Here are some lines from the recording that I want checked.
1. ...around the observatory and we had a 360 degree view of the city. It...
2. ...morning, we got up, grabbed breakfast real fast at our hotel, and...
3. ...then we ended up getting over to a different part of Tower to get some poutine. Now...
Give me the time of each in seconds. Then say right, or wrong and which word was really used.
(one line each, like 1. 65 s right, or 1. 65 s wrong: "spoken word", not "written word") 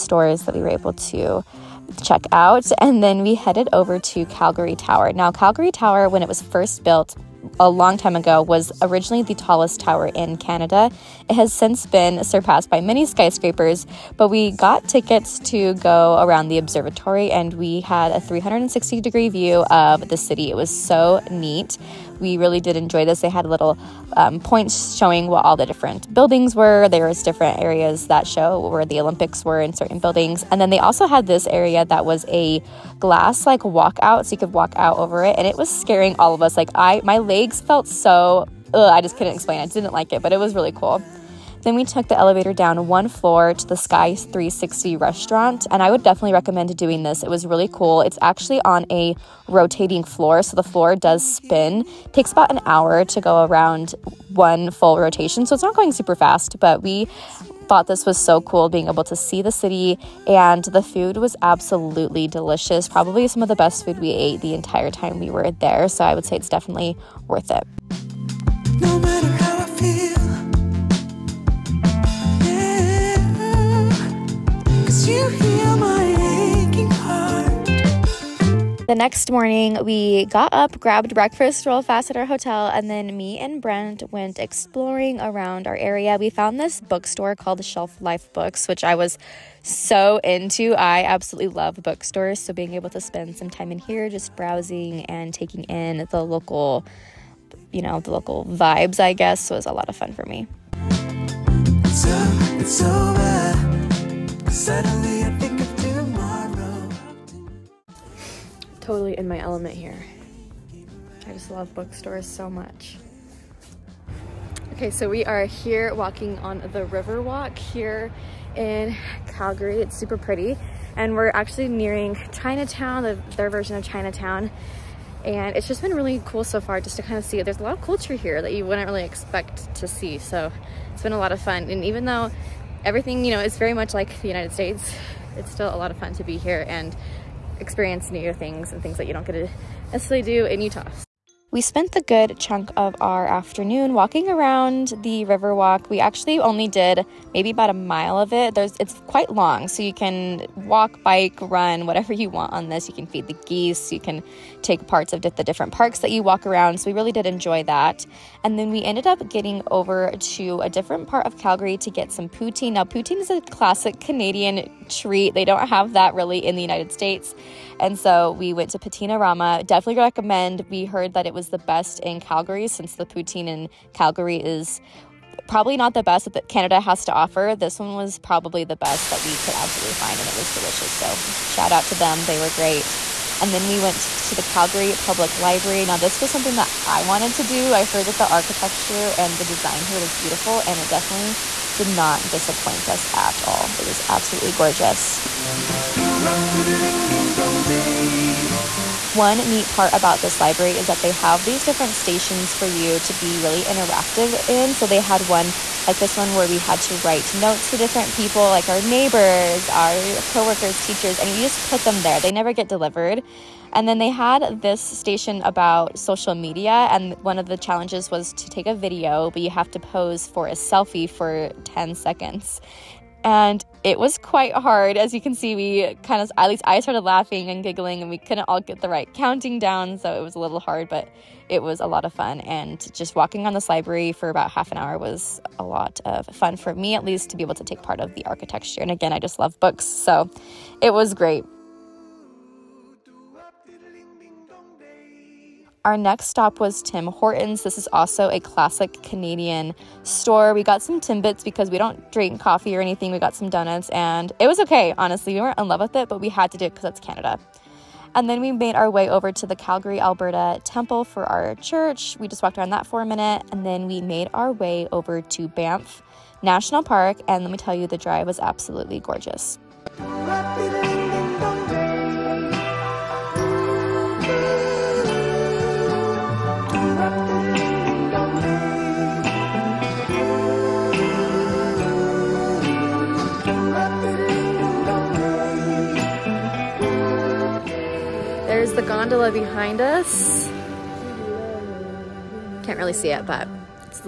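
1. 16 s right
2. 79 s right
3. 158 s wrong: "Calgary", not "Tower".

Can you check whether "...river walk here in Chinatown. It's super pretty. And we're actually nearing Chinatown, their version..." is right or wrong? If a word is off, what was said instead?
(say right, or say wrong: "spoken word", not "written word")
wrong: "Calgary", not "Chinatown".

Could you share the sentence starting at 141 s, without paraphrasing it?
We spent the good chunk of our afternoon walking around the Riverwalk.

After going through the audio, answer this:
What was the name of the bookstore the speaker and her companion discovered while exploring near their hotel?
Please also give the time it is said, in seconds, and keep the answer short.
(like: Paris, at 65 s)
Shelf Life Books, at 87 s.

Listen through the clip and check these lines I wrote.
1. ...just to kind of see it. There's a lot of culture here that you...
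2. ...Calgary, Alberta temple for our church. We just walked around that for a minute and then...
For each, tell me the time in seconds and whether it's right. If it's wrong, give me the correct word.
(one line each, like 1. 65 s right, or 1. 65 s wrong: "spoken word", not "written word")
1. 126 s right
2. 259 s right.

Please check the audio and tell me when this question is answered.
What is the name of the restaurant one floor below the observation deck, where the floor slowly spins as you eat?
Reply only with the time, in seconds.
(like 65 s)
43 s.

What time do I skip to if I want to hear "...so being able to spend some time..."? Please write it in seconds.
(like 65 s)
92 s.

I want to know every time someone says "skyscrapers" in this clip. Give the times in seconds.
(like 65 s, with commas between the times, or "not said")
13 s.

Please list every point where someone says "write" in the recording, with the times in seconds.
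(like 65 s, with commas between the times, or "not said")
206 s.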